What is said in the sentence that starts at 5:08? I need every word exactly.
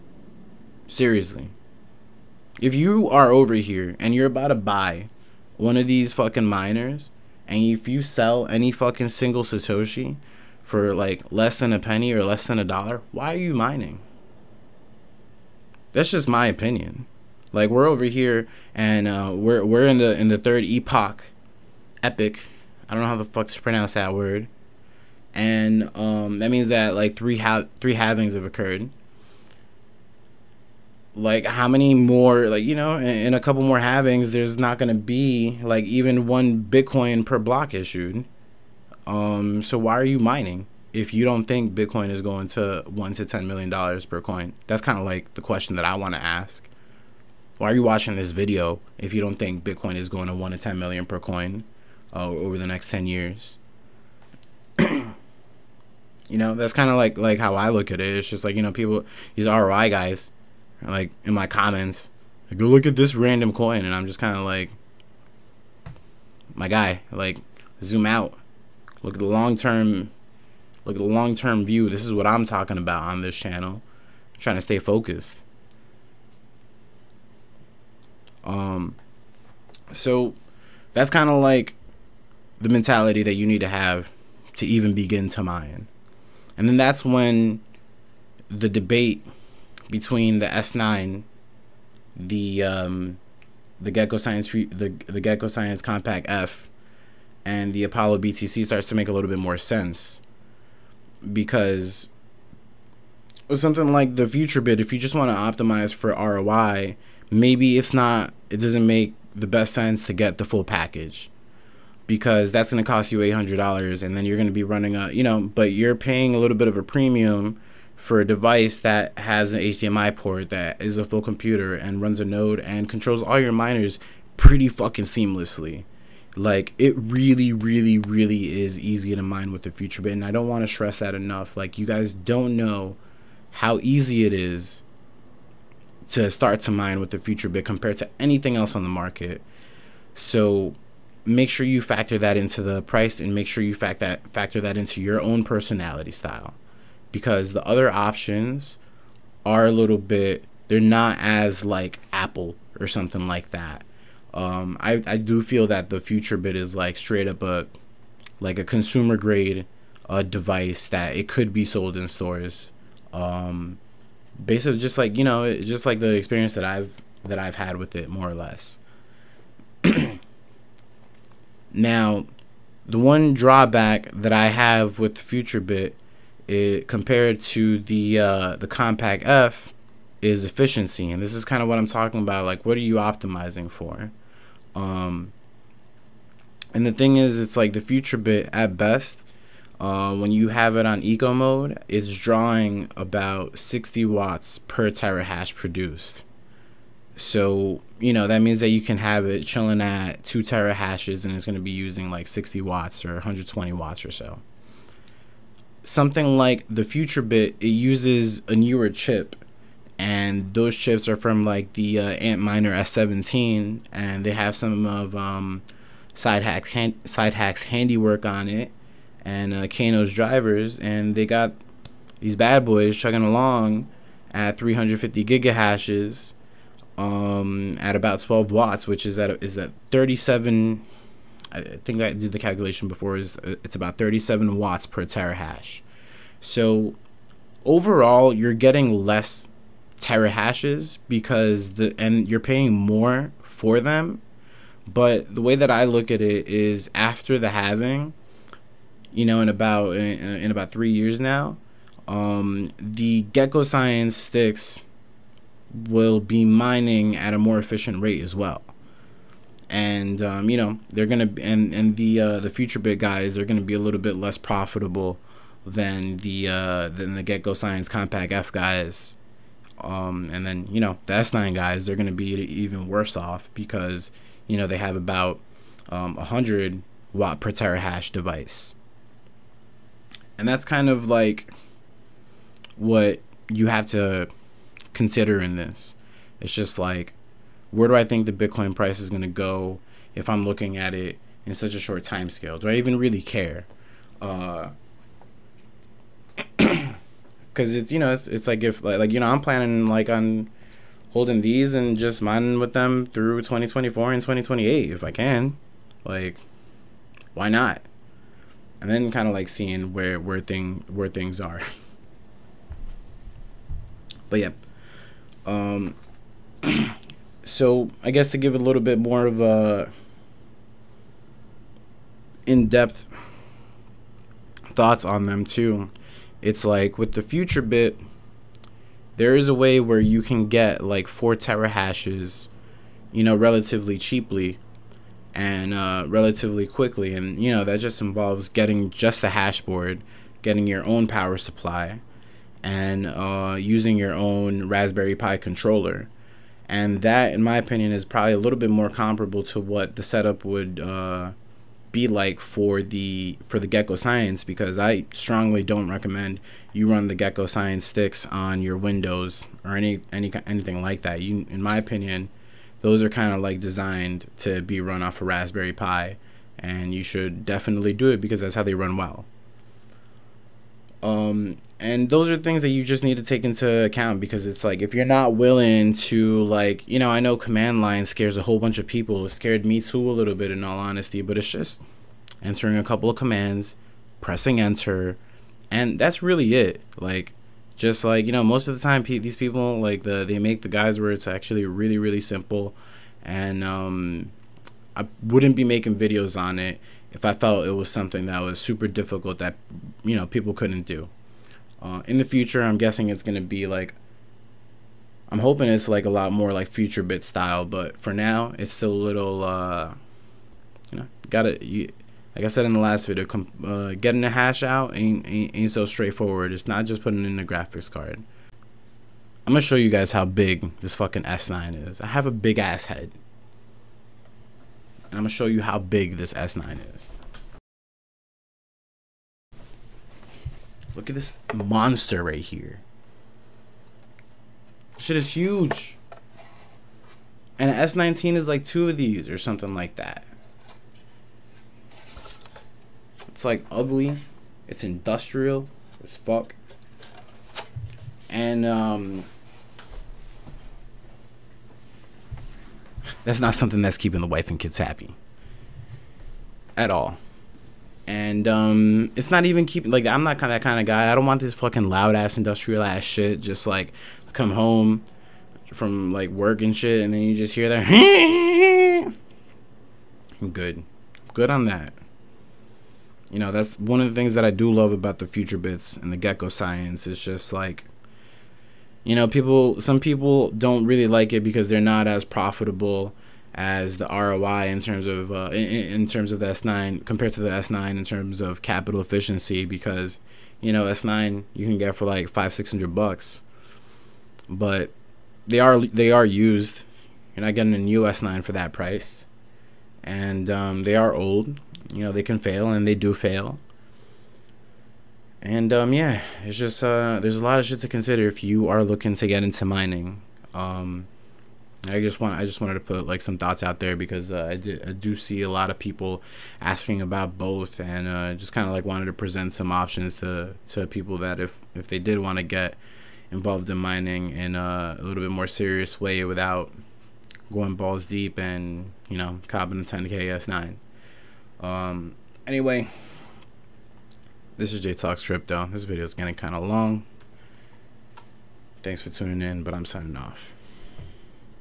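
And then kind of like seeing where where thing where things are.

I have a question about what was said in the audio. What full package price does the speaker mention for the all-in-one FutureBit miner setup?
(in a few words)
$800.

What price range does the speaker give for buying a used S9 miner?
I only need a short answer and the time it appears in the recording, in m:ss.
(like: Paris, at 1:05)
$500-600, at 8:12.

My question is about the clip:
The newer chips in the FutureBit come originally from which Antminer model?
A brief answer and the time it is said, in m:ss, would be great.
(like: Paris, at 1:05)
Antminer S17, at 3:32.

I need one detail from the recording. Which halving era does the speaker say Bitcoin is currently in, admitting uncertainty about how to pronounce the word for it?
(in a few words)
third epoch.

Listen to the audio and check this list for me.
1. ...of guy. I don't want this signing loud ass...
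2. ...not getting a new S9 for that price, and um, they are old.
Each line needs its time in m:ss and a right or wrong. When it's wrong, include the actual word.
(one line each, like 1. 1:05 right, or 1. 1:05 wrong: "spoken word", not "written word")
1. 7:40 wrong: "fucking", not "signing"
2. 8:17 right.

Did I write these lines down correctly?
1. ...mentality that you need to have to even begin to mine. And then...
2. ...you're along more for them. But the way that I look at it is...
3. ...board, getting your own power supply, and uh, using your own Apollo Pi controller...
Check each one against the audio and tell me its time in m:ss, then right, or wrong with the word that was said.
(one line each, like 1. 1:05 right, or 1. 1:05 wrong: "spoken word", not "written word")
1. 1:22 right
2. 4:02 wrong: "paying", not "along"
3. 5:39 wrong: "Raspberry", not "Apollo".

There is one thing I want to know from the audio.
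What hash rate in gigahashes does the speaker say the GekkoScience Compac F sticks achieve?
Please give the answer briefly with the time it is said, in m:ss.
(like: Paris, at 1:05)
350 gigahashes, at 3:44.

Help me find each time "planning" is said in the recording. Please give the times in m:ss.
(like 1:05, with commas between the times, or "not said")
4:59.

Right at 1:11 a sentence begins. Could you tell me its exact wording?
This is what I'm talking about on this channel.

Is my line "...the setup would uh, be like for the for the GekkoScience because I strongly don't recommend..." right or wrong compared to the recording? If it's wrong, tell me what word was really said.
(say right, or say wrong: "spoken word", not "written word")
right.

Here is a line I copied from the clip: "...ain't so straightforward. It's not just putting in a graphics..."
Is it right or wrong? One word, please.
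right.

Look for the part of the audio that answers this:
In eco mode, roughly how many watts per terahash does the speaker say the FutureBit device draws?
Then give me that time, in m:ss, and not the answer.
3:13.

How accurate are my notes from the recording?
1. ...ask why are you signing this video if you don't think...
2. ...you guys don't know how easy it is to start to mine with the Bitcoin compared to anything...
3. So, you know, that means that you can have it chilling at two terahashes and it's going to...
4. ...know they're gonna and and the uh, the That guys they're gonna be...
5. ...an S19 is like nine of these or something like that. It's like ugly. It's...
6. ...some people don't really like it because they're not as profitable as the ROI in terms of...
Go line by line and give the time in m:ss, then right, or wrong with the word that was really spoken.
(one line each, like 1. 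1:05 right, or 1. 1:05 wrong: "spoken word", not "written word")
1. 0:46 wrong: "watching", not "signing"
2. 2:11 wrong: "FutureBit", not "Bitcoin"
3. 3:17 right
4. 4:20 wrong: "FutureBit", not "That"
5. 7:17 wrong: "two", not "nine"
6. 7:59 right.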